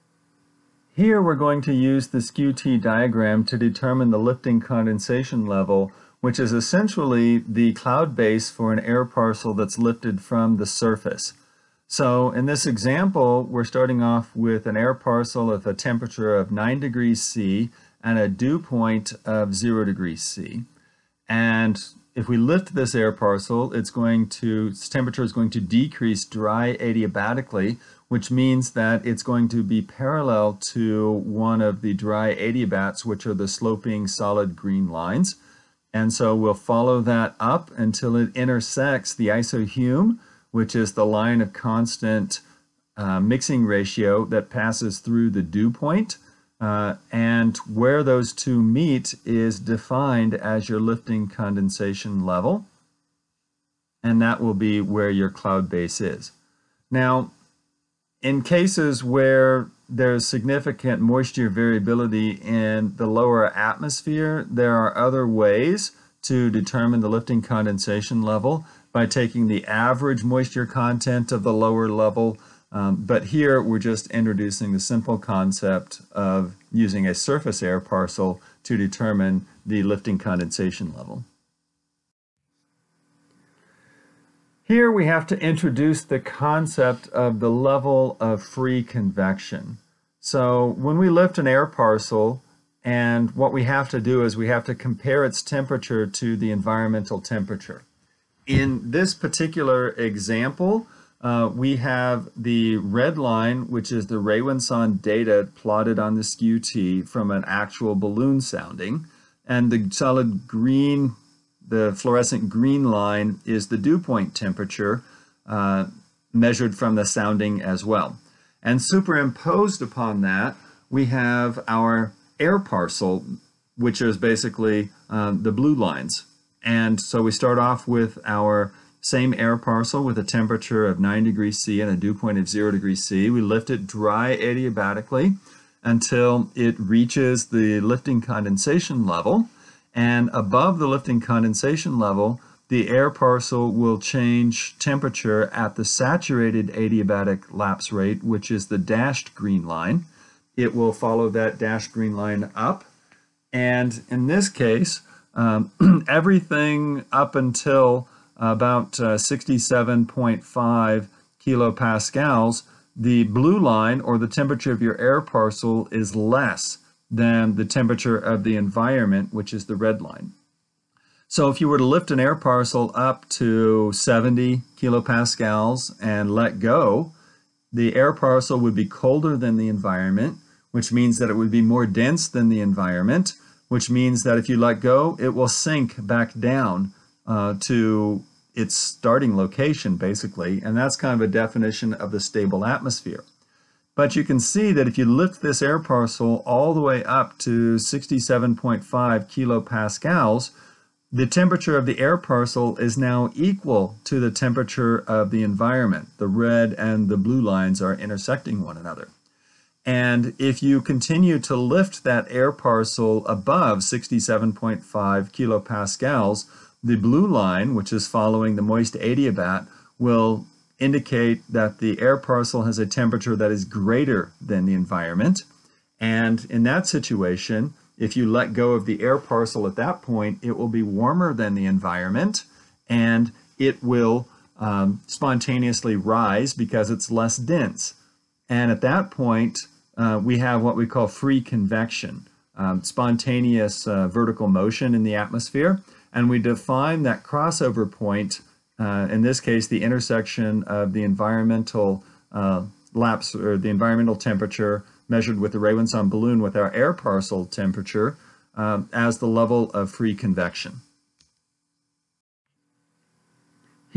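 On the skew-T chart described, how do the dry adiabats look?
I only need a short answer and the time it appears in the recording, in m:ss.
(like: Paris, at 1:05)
sloping solid green lines, at 0:33.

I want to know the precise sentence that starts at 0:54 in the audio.
And that will be where your cloud base is.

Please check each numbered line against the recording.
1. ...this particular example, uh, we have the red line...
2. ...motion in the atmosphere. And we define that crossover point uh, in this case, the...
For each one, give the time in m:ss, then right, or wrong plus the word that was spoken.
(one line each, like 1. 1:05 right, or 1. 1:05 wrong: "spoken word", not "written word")
1. 1:38 right
2. 4:04 right.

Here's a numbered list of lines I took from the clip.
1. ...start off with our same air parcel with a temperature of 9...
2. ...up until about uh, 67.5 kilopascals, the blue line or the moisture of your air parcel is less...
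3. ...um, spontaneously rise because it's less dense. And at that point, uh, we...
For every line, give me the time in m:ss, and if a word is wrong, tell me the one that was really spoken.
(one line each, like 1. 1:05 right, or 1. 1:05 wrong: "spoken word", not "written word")
1. 2:07 right
2. 2:37 wrong: "temperature", not "moisture"
3. 3:54 right.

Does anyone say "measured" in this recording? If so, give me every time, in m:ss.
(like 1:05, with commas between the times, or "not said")
1:56, 4:15.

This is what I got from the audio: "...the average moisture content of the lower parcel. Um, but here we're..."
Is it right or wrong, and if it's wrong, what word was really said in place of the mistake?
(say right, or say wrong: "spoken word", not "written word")
wrong: "level", not "parcel".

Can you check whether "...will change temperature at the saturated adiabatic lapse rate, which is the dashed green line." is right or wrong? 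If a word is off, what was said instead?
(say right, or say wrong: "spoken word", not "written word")
right.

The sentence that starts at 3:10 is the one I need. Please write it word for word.
And that's kind of a definition of the stable atmosphere.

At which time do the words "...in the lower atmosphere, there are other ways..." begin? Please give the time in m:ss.
1:02.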